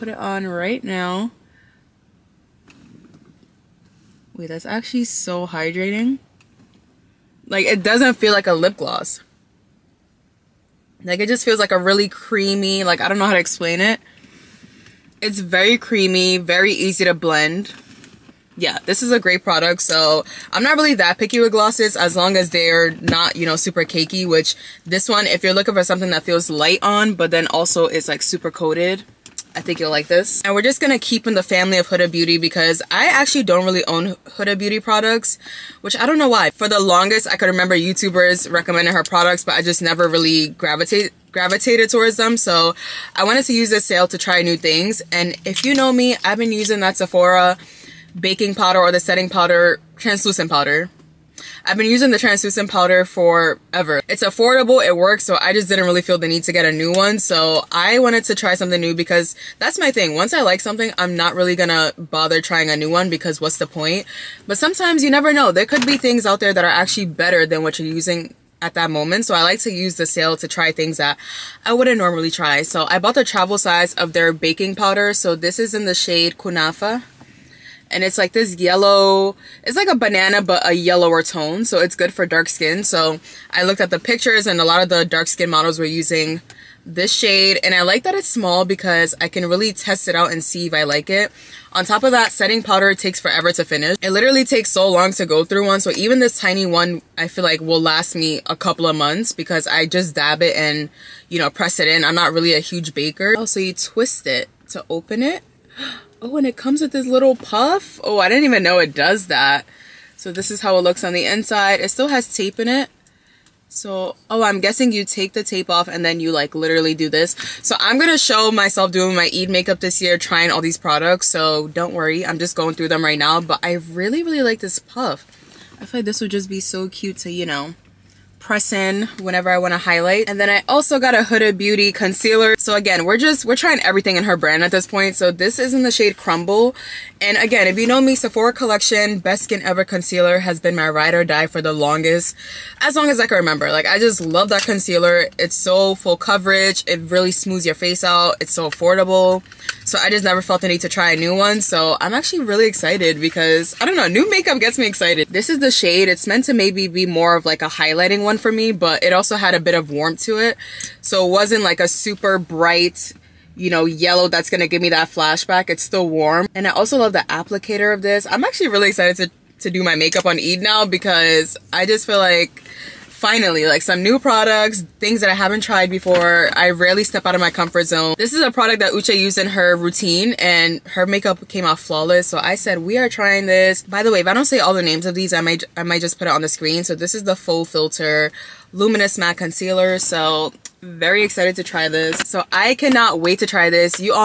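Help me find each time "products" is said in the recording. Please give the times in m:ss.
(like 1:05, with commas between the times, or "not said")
0:19, 0:34, 0:39, 2:00, 2:54, 2:58.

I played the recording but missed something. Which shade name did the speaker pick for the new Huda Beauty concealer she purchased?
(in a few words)
Crumble.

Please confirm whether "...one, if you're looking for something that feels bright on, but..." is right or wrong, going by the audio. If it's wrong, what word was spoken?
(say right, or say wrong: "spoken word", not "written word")
wrong: "light", not "bright".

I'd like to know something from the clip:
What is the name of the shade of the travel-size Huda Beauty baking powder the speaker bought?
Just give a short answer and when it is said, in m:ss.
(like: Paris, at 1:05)
Kunafa, at 1:16.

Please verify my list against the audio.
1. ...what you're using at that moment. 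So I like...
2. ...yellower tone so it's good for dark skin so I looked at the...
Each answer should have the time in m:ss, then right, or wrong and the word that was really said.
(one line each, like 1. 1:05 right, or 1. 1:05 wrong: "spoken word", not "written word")
1. 1:07 right
2. 1:20 right.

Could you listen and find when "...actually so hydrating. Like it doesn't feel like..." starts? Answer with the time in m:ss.
0:04.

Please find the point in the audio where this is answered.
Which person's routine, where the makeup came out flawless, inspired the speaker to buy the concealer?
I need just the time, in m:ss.
2:58.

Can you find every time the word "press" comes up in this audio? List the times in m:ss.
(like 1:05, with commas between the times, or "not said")
1:41, 2:08.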